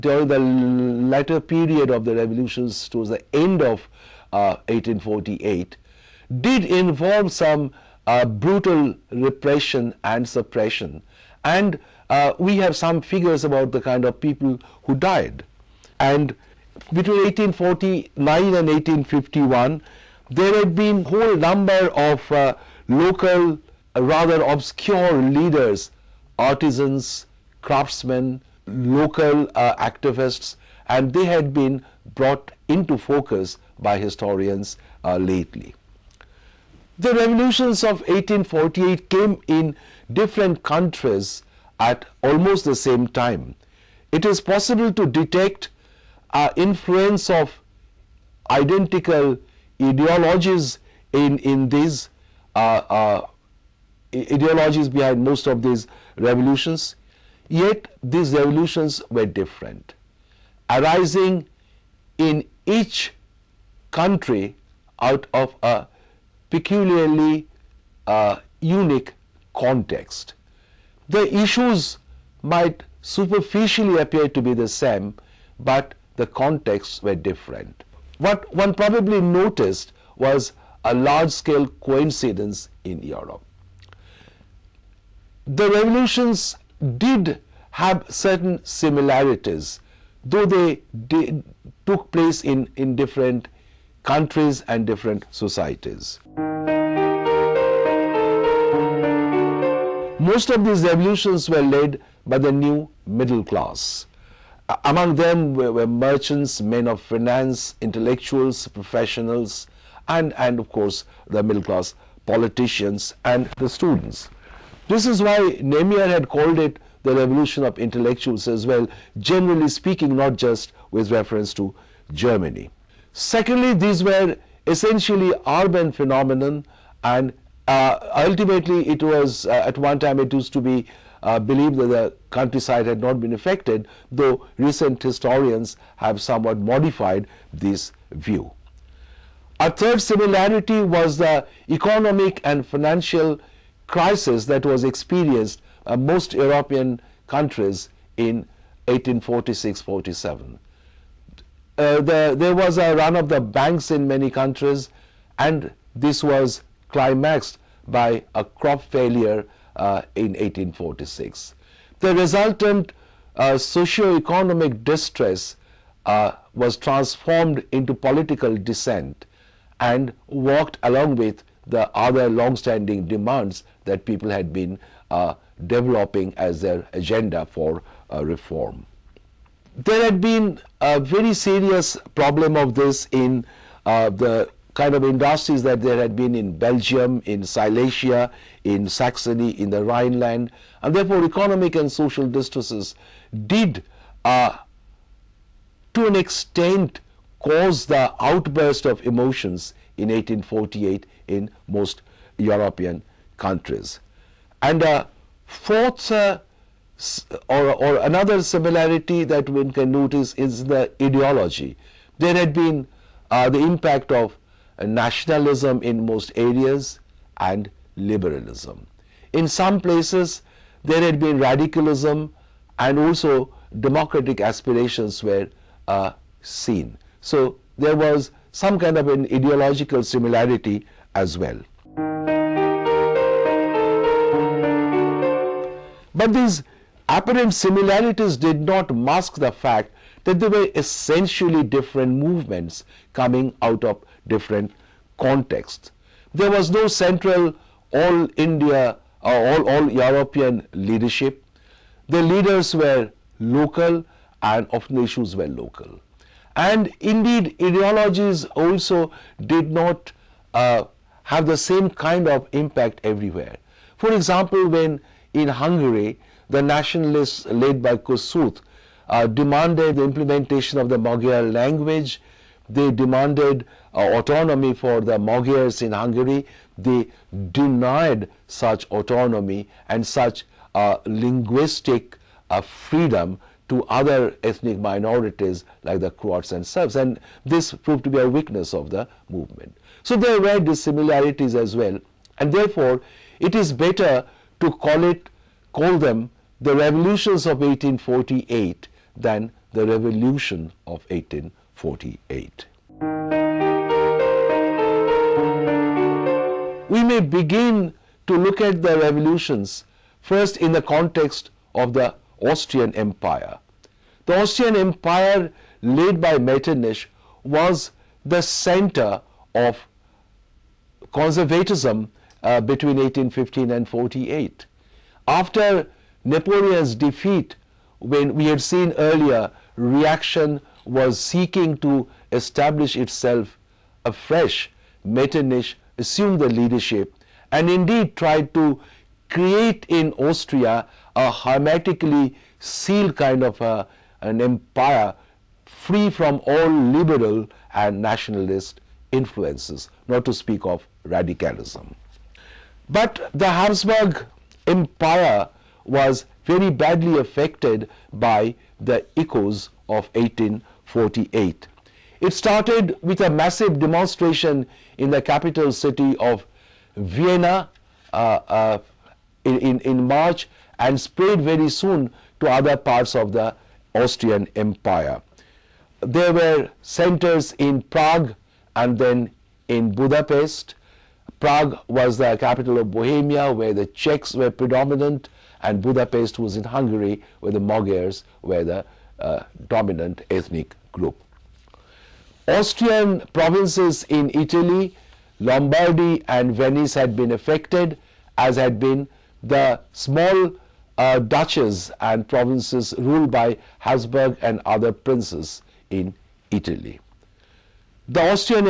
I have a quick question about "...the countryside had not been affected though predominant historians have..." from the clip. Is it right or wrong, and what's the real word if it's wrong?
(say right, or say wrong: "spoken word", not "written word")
wrong: "recent", not "predominant".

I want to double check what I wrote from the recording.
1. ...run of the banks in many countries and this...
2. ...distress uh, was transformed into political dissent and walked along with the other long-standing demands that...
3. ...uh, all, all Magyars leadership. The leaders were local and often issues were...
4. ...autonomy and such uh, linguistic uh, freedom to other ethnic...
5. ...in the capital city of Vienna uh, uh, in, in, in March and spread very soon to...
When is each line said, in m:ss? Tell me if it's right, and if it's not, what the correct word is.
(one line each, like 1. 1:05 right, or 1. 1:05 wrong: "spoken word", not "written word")
1. 2:32 right
2. 2:44 right
3. 4:09 wrong: "European", not "Magyars"
4. 4:38 right
5. 6:04 right.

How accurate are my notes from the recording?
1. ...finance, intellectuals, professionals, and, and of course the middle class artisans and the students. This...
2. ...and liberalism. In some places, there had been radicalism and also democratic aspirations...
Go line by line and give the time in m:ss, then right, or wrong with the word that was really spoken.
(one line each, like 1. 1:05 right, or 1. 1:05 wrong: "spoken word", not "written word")
1. 1:47 wrong: "politicians", not "artisans"
2. 3:37 right.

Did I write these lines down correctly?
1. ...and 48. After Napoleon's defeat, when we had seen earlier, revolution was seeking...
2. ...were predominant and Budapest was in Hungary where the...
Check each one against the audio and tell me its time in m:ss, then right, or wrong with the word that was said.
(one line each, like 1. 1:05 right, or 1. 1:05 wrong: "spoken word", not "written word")
1. 5:23 wrong: "reaction", not "revolution"
2. 6:24 right.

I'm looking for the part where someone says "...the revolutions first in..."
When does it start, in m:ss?
5:08.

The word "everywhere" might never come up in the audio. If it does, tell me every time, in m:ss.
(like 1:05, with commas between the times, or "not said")
4:23.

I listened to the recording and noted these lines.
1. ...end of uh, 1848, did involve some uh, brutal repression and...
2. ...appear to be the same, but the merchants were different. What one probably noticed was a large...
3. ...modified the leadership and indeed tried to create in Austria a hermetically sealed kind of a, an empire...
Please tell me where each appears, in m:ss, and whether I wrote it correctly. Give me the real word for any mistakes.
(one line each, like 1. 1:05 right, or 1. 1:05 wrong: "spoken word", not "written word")
1. 0:03 right
2. 1:14 wrong: "contexts", not "merchants"
3. 5:35 wrong: "assumed", not "modified".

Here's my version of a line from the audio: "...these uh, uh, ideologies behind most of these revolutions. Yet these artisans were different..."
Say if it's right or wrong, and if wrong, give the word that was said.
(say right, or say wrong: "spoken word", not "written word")
wrong: "revolutions", not "artisans".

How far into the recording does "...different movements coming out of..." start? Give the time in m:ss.
4:01.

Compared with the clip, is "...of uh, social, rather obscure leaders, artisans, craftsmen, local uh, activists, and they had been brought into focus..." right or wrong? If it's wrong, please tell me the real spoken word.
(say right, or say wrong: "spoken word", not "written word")
wrong: "local", not "social".